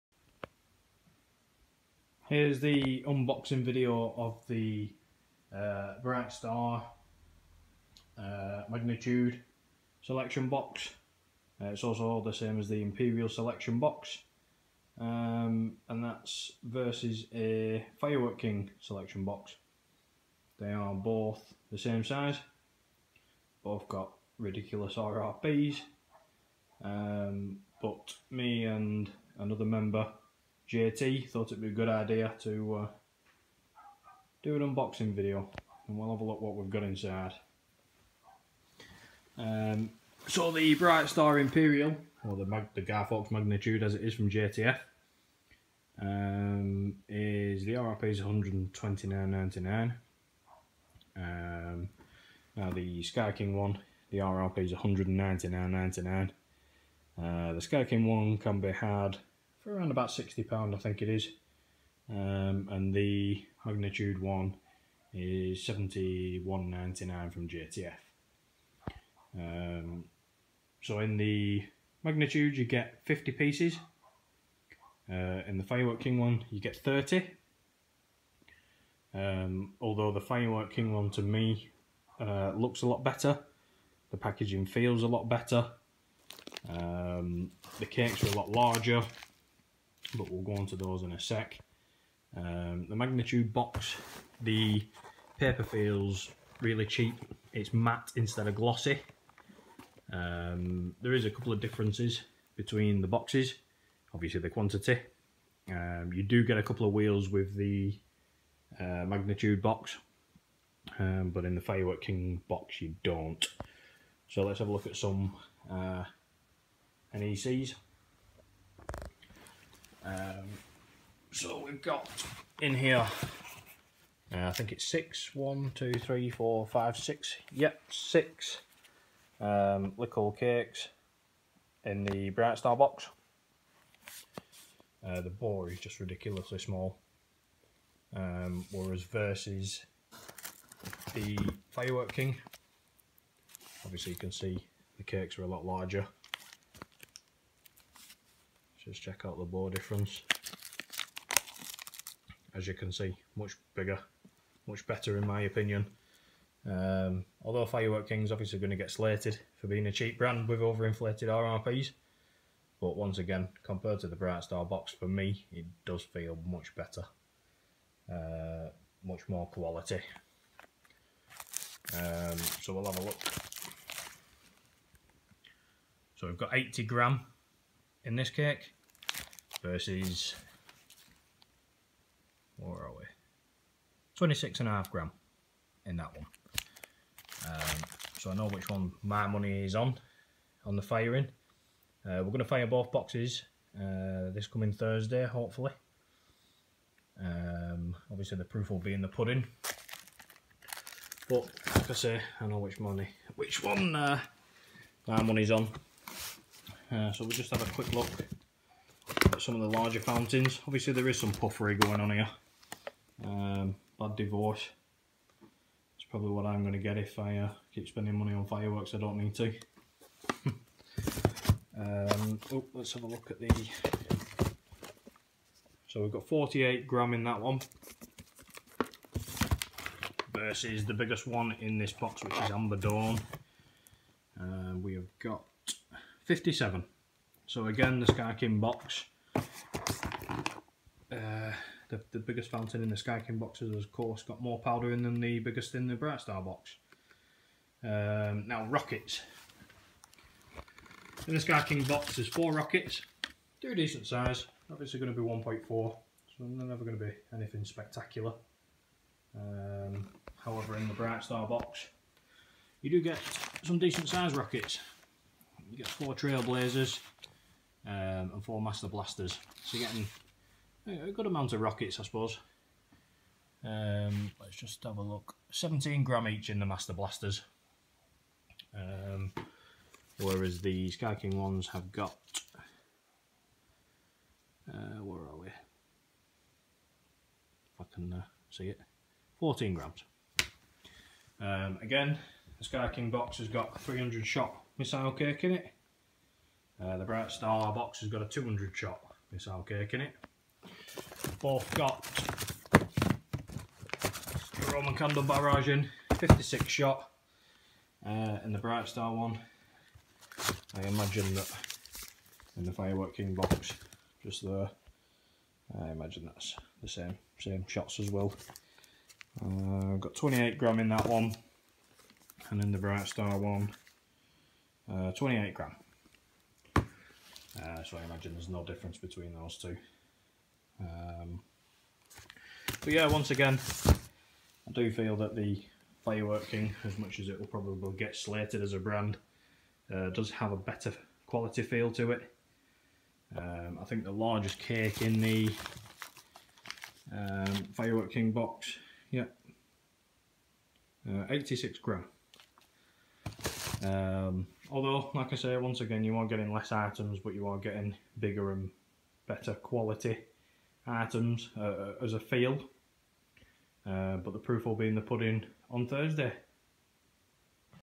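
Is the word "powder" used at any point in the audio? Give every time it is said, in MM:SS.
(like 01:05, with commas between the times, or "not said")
04:04.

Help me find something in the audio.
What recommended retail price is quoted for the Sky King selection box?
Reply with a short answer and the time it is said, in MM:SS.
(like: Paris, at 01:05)
£199.99, at 00:54.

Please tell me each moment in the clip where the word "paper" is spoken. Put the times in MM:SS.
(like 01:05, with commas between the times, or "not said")
01:35.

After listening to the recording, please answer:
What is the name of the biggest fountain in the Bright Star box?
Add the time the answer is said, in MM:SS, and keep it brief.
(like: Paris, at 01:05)
Amber Dawn, at 03:52.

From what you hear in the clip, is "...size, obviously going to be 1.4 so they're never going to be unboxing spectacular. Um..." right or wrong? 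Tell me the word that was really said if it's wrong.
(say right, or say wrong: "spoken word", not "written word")
wrong: "anything", not "unboxing".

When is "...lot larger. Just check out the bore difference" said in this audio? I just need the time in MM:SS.
02:25.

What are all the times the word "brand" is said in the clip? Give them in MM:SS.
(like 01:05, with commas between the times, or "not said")
02:40, 05:38.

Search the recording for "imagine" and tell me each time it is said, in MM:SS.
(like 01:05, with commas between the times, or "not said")
05:10, 05:15, 05:28.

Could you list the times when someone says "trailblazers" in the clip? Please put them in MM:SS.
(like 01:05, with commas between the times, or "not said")
04:26.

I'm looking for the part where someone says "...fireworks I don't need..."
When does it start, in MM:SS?
03:38.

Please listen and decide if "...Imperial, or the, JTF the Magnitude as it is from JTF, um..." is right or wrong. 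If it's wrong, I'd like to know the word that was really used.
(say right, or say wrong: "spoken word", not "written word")
wrong: "Mag", not "JTF".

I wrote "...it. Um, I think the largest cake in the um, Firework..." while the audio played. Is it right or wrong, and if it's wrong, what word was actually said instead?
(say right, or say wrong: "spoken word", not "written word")
right.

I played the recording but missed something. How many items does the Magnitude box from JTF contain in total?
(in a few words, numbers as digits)
50.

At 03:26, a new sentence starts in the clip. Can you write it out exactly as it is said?
Uh, so we'll just have a quick look some of the larger fountains.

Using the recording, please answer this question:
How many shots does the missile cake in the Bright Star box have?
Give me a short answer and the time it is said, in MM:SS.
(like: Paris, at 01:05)
200, at 04:58.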